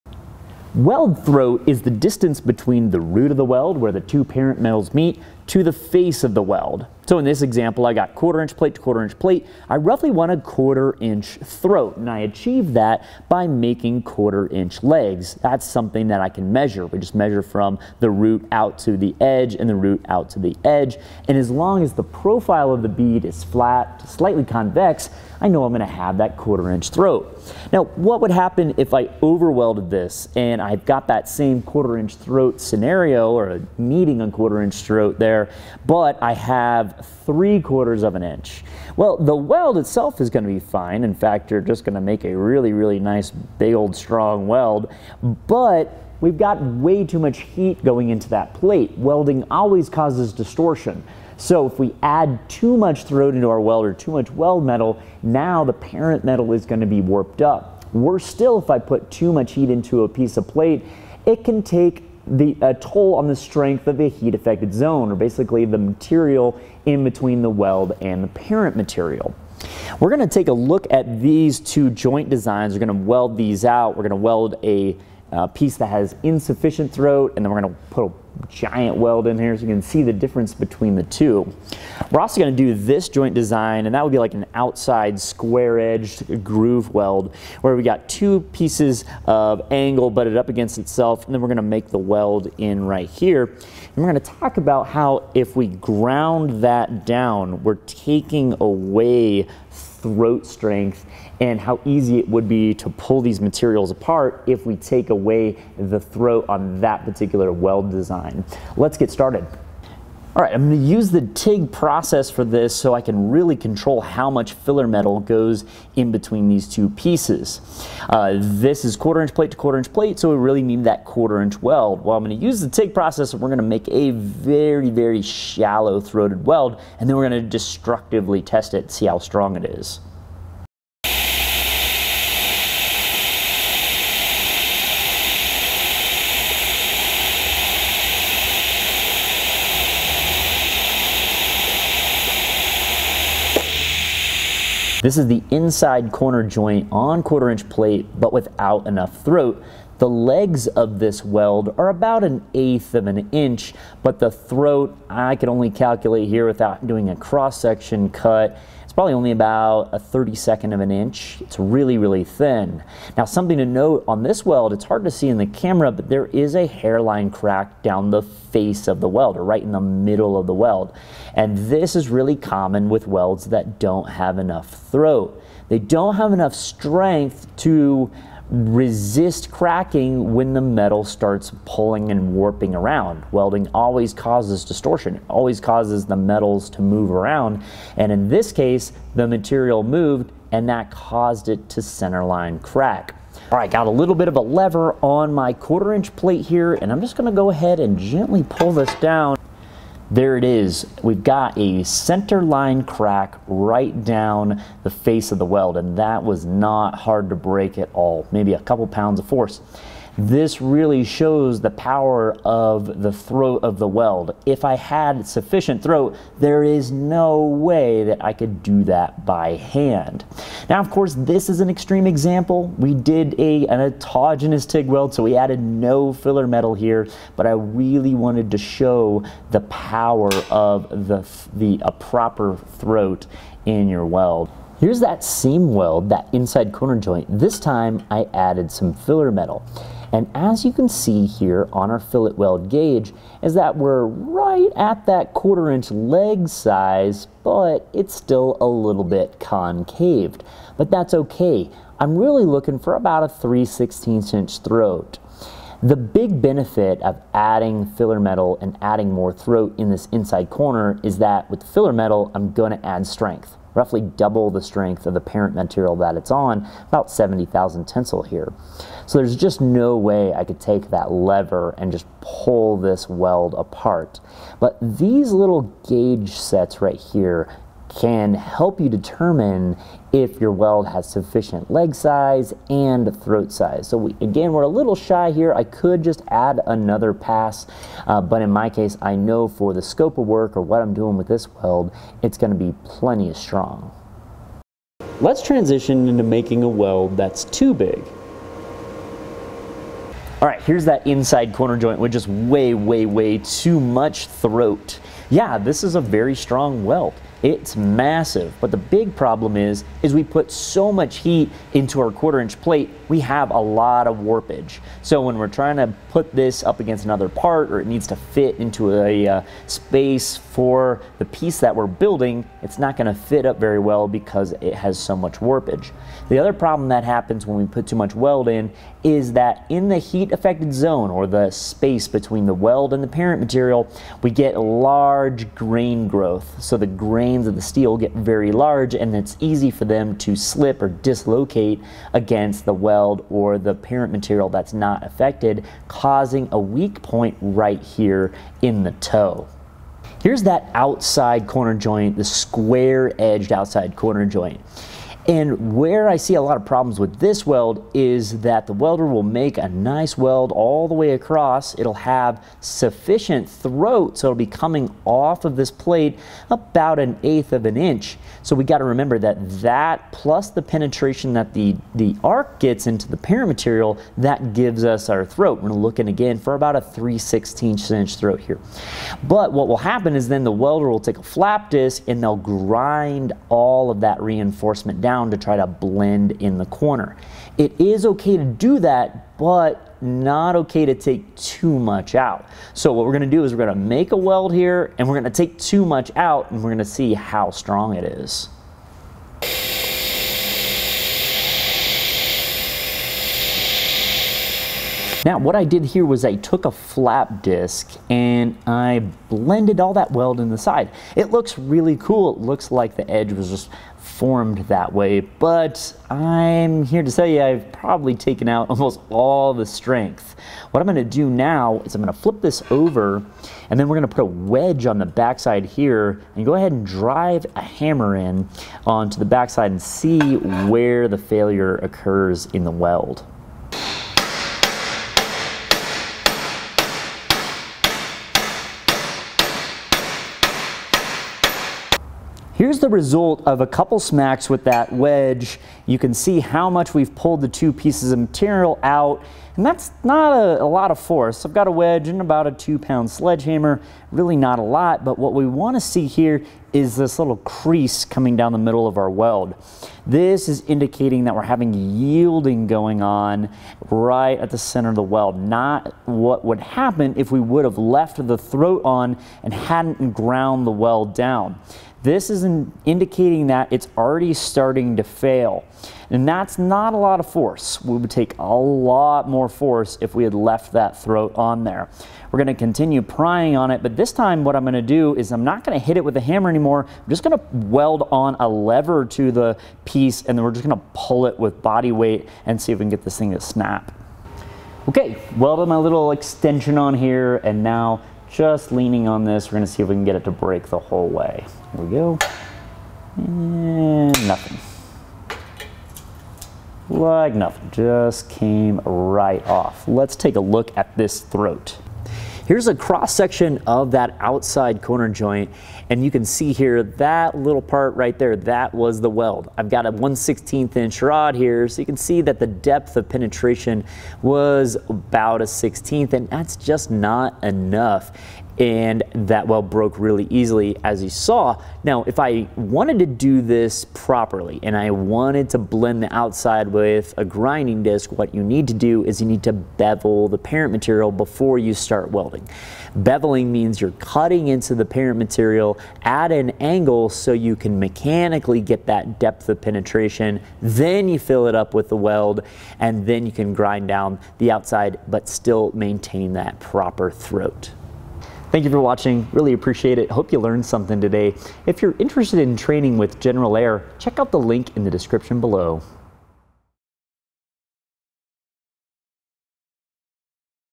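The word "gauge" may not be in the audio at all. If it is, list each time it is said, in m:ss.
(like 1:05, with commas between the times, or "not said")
4:02, 4:35.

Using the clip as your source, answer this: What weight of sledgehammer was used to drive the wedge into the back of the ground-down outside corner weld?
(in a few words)
2 pounds.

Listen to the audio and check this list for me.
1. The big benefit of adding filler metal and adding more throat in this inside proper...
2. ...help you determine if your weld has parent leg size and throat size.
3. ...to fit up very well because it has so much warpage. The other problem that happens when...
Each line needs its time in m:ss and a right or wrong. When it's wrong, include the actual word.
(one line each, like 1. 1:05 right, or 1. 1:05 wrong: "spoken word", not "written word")
1. 4:15 wrong: "corner", not "proper"
2. 4:38 wrong: "sufficient", not "parent"
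3. 5:23 right.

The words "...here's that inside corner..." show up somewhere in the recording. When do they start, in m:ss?
5:00.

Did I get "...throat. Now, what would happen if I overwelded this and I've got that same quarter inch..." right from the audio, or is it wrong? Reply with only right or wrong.
right.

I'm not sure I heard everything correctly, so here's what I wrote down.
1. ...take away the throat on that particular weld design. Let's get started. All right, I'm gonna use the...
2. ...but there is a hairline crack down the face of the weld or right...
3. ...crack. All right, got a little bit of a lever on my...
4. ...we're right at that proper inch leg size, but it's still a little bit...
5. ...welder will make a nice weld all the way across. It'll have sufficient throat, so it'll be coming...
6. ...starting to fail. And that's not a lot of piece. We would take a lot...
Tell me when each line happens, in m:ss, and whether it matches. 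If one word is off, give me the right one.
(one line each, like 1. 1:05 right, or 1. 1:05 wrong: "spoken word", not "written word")
1. 1:44 right
2. 2:45 right
3. 3:12 right
4. 4:03 wrong: "quarter", not "proper"
5. 5:58 right
6. 7:54 wrong: "force", not "piece".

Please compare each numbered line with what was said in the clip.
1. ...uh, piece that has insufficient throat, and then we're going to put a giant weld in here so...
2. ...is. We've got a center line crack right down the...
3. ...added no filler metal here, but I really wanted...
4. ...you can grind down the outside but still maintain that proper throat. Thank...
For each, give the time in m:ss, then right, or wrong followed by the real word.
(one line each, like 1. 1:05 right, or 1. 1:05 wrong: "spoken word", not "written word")
1. 1:15 right
2. 3:20 right
3. 3:45 right
4. 9:13 right.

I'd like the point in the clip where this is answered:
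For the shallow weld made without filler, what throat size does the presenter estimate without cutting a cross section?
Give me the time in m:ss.
2:39.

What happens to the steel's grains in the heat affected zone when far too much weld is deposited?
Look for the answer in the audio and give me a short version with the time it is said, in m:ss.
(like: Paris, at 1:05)
Large grain growth, at 5:34.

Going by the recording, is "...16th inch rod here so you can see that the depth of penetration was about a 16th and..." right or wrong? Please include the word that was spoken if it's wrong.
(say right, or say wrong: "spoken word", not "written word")
right.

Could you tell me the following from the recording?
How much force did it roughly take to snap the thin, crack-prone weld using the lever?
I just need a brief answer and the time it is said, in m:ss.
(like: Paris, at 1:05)
A couple pounds, at 3:28.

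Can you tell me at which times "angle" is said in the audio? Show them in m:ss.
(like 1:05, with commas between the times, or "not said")
1:29, 9:06.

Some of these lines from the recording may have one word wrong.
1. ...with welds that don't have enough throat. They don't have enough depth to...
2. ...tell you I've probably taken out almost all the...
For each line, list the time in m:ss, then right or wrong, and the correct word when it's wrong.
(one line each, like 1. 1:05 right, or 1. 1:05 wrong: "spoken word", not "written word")
1. 2:52 wrong: "strength", not "depth"
2. 6:57 right.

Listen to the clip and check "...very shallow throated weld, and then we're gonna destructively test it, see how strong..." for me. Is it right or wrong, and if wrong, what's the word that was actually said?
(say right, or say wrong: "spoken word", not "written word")
right.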